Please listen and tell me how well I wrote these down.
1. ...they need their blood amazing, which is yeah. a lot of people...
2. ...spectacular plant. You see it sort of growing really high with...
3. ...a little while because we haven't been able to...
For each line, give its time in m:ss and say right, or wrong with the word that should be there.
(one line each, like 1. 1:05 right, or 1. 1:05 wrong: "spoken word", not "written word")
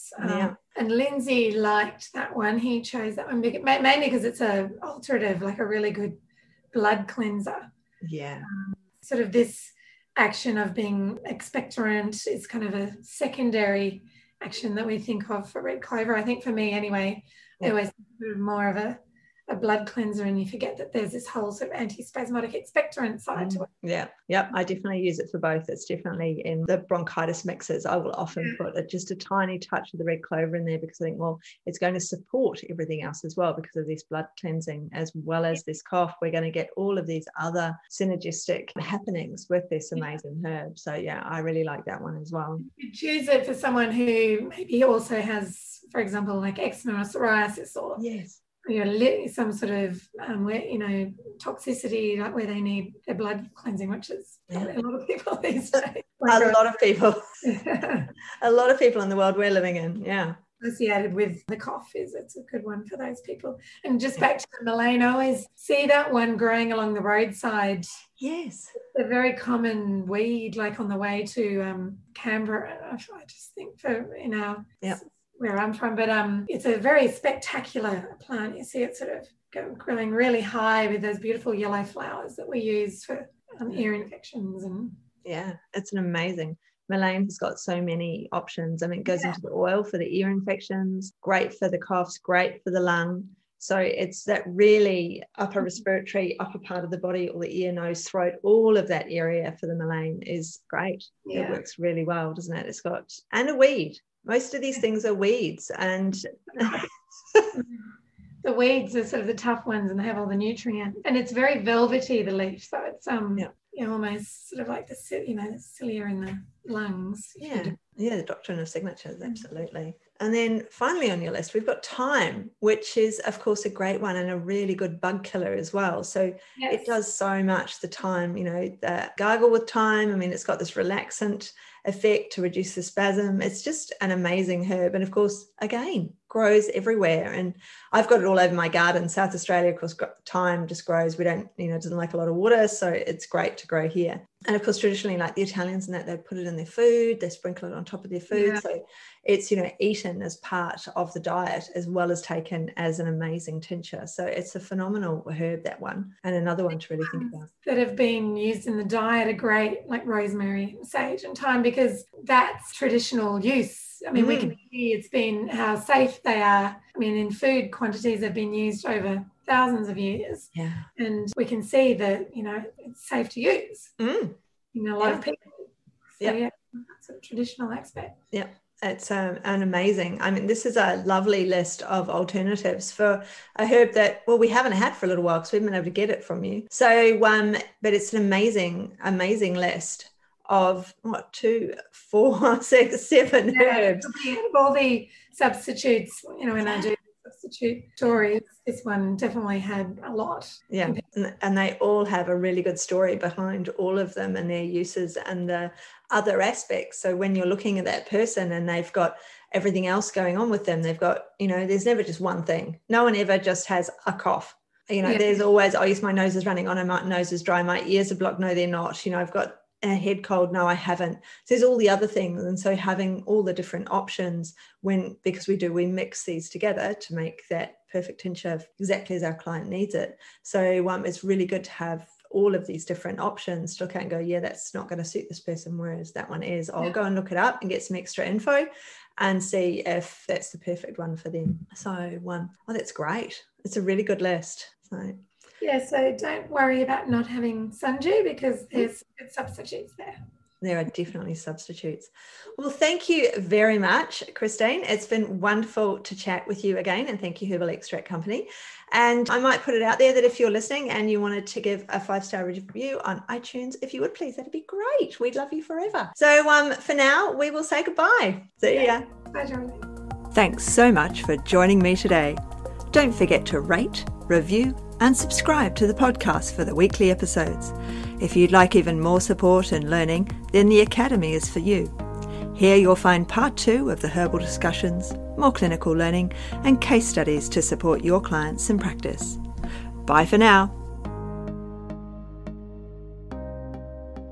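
1. 0:52 wrong: "cleansing", not "amazing"
2. 1:17 right
3. 3:05 right.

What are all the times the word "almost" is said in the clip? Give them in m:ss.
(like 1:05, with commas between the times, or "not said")
1:53.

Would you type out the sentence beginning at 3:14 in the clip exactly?
All the substitutes, you know, when I do substitute stories, this one definitely had a lot.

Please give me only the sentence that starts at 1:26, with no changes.
Mullein has got so many options.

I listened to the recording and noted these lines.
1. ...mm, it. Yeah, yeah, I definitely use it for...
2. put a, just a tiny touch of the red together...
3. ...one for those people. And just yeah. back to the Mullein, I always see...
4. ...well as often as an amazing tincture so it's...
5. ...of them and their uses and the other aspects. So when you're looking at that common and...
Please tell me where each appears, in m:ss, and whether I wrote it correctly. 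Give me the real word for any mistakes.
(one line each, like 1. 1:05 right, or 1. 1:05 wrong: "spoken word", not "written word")
1. 0:23 right
2. 0:28 wrong: "clover", not "together"
3. 1:02 right
4. 2:31 wrong: "taken", not "often"
5. 3:23 wrong: "person", not "common".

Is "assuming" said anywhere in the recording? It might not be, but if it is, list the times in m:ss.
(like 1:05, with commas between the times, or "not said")
not said.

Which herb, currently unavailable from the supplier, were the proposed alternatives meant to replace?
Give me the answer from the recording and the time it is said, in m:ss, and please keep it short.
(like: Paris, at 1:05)
Sundew, at 4:07.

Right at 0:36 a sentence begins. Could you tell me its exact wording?
We're going to get all of these other synergistic happenings with this amazing yeah.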